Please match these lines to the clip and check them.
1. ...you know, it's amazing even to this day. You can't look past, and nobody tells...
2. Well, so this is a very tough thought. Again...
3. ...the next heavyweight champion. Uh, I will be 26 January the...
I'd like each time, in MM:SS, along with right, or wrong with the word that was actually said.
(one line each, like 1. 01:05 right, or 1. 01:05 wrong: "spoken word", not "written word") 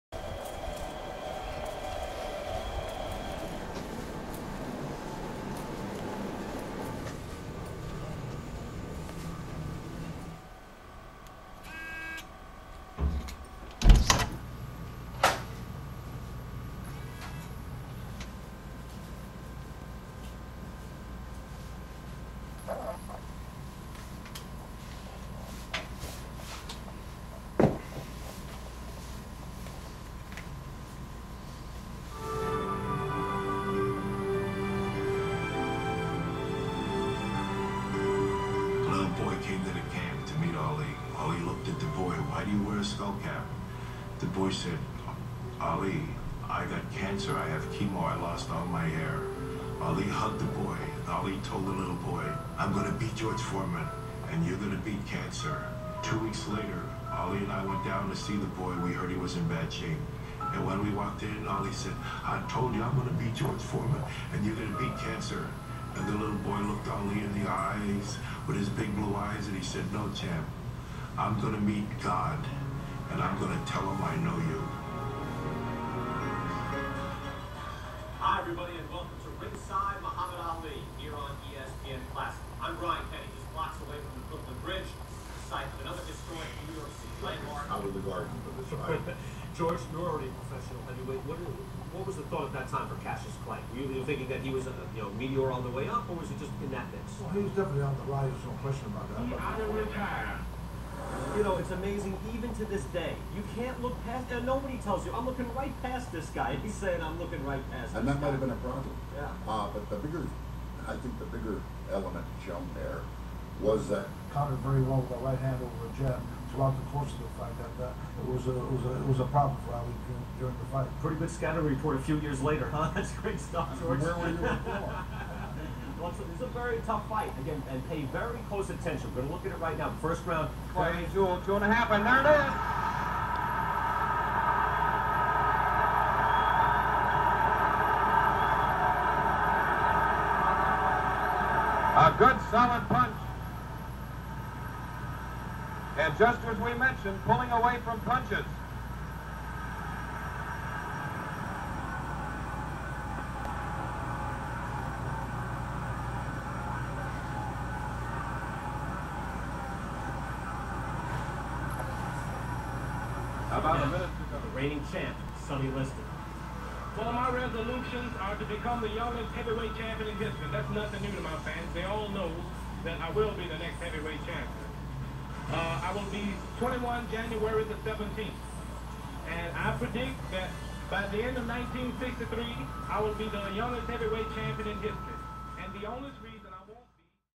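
1. 01:41 right
2. 02:06 wrong: "fight", not "thought"
3. 02:53 wrong: "21", not "26".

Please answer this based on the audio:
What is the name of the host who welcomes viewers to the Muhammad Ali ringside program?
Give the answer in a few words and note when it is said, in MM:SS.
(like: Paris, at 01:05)
Brian Kenny, at 01:22.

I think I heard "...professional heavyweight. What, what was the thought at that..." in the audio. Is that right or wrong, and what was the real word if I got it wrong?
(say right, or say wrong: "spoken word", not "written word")
right.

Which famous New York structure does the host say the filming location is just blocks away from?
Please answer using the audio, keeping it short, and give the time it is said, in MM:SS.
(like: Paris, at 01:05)
Brooklyn Bridge, at 01:24.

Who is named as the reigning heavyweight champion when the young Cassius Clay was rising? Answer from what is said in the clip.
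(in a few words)
Sonny Liston.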